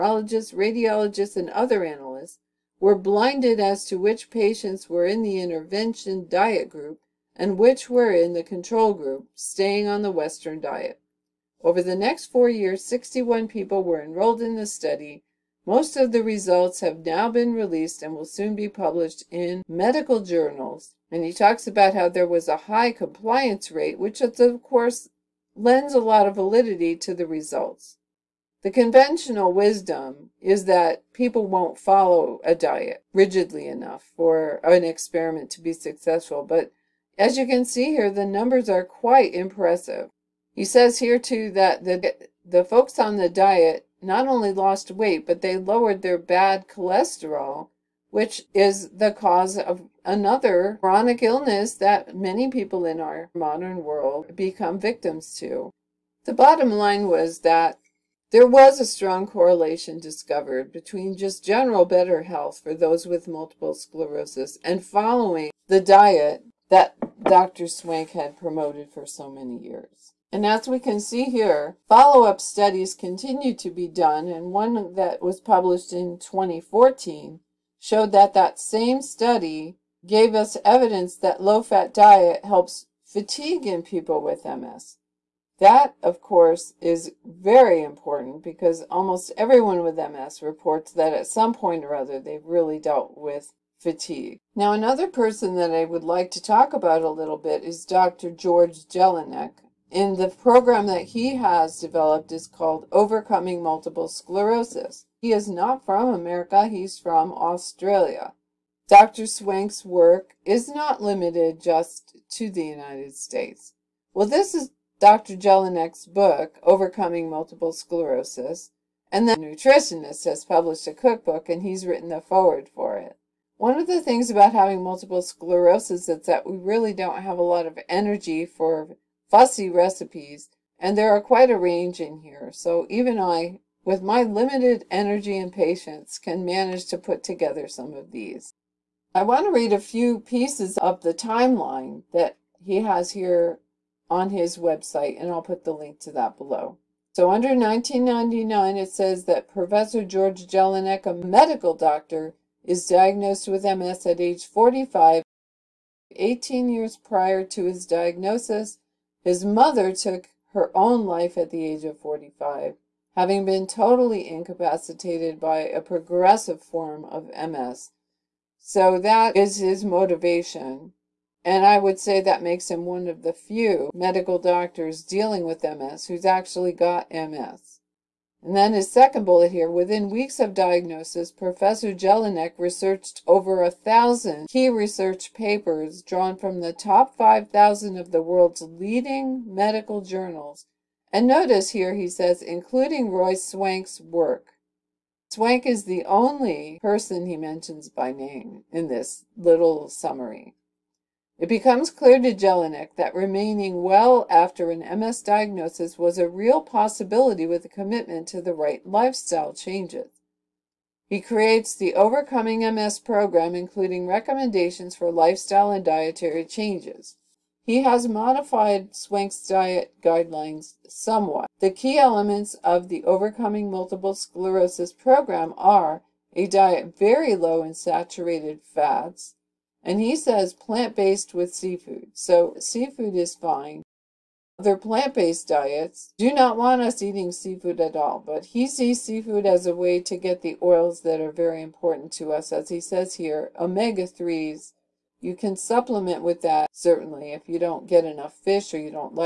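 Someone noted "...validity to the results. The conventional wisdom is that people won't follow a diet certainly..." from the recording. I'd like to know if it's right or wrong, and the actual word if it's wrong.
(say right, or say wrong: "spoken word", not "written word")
wrong: "rigidly", not "certainly".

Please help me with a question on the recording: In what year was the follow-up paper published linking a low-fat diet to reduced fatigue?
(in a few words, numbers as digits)
2014.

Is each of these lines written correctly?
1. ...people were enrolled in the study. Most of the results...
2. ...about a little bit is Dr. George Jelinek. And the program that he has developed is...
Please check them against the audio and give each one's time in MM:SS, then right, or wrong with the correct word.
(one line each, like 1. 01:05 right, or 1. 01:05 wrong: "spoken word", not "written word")
1. 00:13 right
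2. 01:36 right.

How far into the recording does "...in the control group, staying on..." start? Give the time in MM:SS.
00:08.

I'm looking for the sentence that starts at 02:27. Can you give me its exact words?
So under 1999, it says that Professor George Jelinek, a medical doctor, is diagnosed with MS at age 45.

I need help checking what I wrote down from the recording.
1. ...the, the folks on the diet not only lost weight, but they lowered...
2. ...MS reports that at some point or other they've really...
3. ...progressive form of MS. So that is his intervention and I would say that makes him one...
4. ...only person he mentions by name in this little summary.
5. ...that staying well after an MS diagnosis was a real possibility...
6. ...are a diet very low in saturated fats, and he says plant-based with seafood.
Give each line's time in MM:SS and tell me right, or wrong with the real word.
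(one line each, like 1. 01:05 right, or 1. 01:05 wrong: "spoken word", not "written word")
1. 00:41 right
2. 01:29 right
3. 02:45 wrong: "motivation", not "intervention"
4. 03:16 right
5. 03:22 wrong: "remaining", not "staying"
6. 03:45 right.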